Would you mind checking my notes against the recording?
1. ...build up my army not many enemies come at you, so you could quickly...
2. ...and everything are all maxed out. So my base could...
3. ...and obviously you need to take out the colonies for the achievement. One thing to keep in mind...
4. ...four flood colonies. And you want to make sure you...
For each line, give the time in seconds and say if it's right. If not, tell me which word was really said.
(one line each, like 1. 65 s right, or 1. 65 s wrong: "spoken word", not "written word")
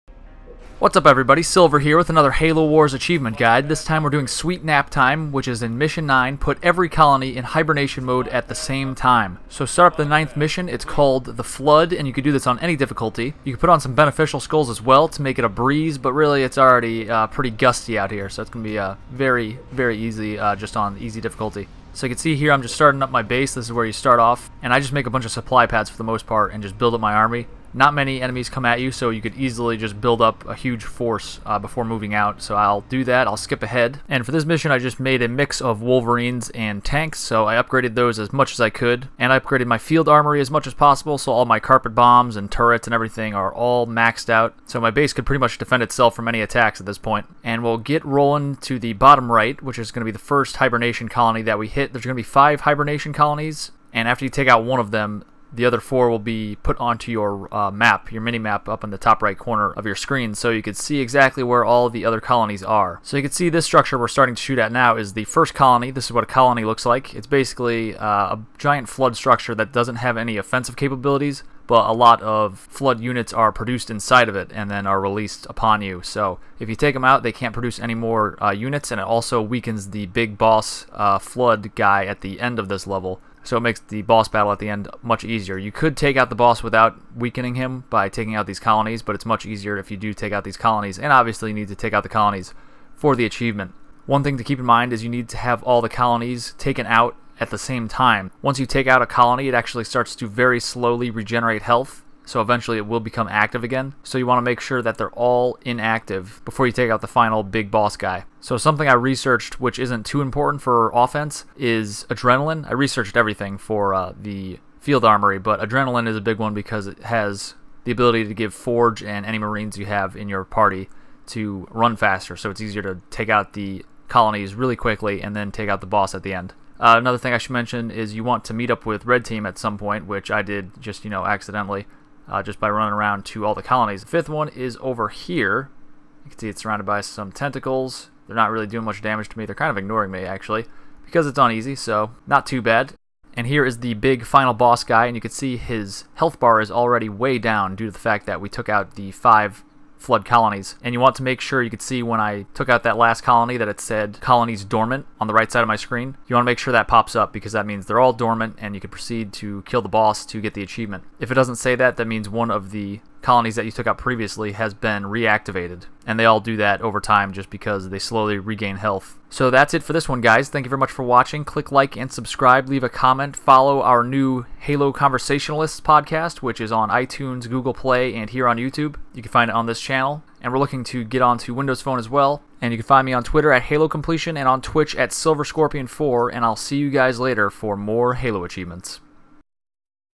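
1. 26 s wrong: "easily", not "quickly"
2. 42 s right
3. 90 s right
4. 149 s wrong: "five", not "four".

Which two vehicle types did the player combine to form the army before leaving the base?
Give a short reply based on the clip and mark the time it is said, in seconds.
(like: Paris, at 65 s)
Wolverines and tanks, at 35 s.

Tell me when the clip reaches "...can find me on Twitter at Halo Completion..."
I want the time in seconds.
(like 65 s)
182 s.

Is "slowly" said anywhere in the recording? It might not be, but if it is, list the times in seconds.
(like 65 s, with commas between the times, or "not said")
100 s, 167 s.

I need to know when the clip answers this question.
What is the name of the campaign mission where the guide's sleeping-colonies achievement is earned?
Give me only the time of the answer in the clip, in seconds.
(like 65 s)
11 s.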